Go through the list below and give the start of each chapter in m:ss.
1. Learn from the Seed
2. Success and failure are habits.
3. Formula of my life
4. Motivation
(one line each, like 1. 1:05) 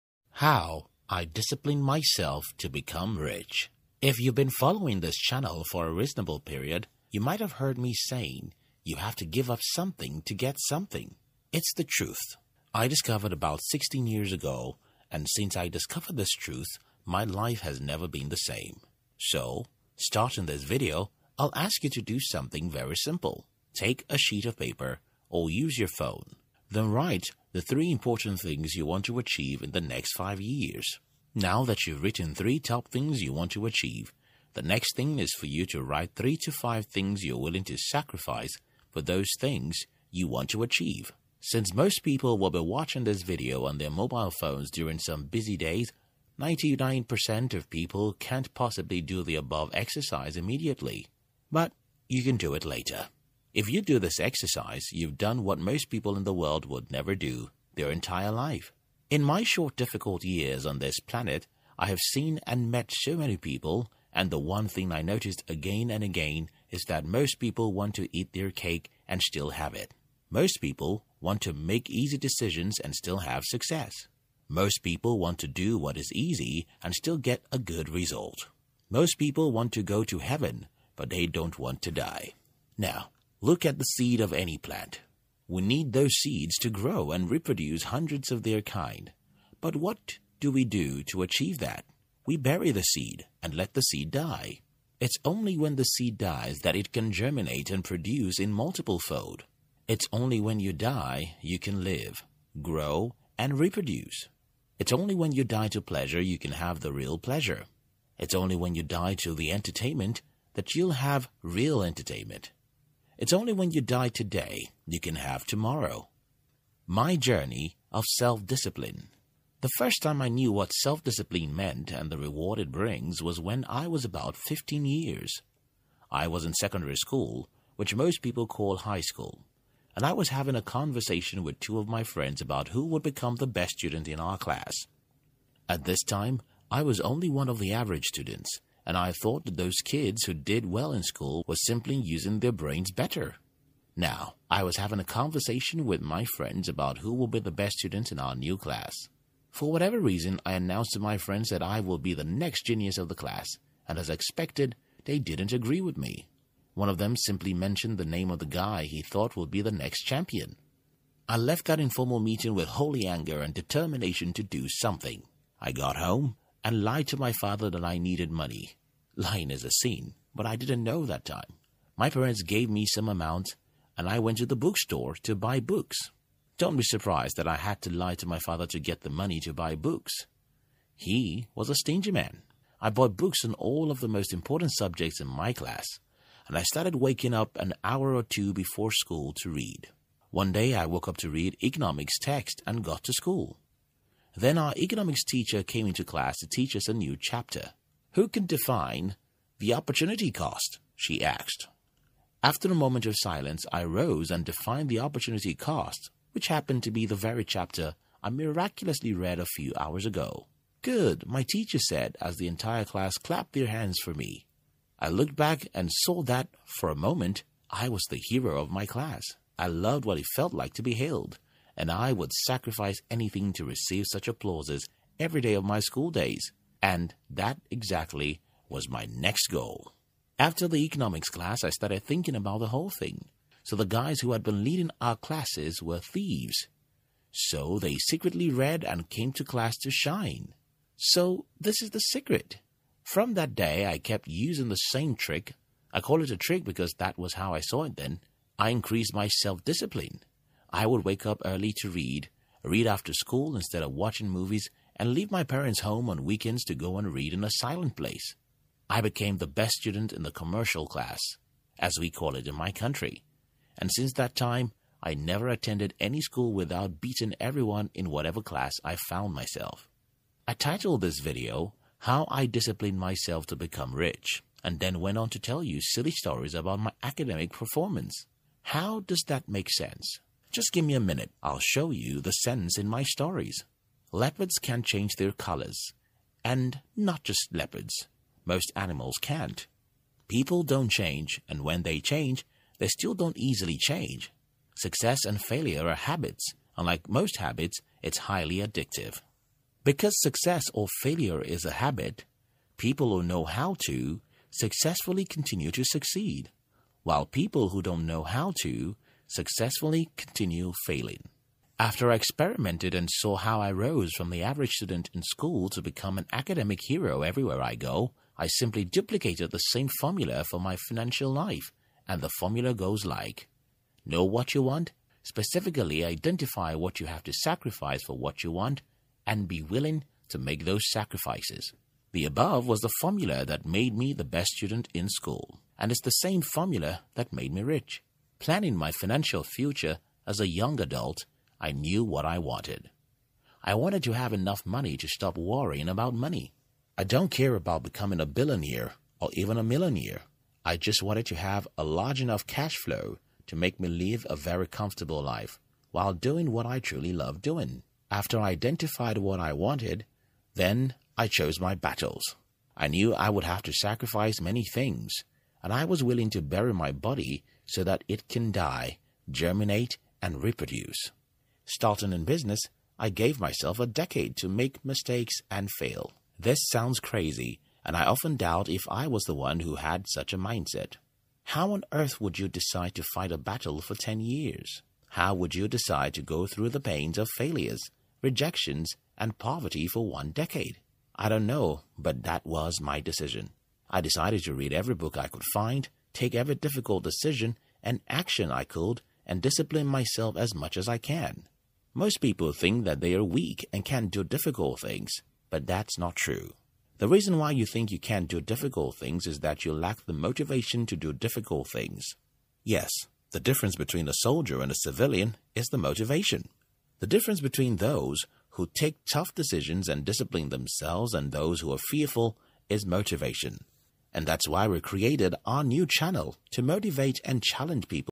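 1. 1:23
2. 4:52
3. 5:17
4. 6:38.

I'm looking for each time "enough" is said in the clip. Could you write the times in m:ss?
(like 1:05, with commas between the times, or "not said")
5:44, 5:52.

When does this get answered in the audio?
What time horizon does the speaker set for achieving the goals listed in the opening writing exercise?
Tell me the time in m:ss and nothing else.
0:29.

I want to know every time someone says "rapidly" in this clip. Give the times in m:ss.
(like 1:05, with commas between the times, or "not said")
not said.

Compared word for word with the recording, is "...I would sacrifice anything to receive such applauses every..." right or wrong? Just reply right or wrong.
right.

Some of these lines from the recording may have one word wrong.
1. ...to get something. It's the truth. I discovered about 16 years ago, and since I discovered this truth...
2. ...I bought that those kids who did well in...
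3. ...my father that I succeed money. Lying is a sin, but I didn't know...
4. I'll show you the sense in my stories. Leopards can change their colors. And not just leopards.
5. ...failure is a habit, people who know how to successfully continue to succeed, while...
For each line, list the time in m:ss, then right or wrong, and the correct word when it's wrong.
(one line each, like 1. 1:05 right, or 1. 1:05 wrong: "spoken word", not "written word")
1. 0:10 right
2. 2:18 wrong: "thought", not "bought"
3. 2:47 wrong: "needed", not "succeed"
4. 4:41 right
5. 5:01 right.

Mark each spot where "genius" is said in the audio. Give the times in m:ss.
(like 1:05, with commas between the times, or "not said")
2:32.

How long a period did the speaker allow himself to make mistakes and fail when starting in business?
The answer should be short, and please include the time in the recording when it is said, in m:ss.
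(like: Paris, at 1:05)
A decade, at 6:13.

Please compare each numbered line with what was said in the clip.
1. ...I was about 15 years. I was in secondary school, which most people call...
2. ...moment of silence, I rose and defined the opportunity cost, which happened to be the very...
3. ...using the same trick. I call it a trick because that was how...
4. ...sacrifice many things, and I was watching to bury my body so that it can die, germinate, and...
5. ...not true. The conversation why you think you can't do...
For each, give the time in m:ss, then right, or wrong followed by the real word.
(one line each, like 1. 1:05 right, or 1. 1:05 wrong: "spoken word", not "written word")
1. 2:03 right
2. 3:22 right
3. 4:04 right
4. 6:03 wrong: "willing", not "watching"
5. 6:45 wrong: "reason", not "conversation".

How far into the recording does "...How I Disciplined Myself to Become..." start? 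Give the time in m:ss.
4:31.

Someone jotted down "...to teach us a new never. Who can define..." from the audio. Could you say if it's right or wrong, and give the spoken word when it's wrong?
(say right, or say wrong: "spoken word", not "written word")
wrong: "chapter", not "never".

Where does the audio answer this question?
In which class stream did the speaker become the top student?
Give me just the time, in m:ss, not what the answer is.
4:20.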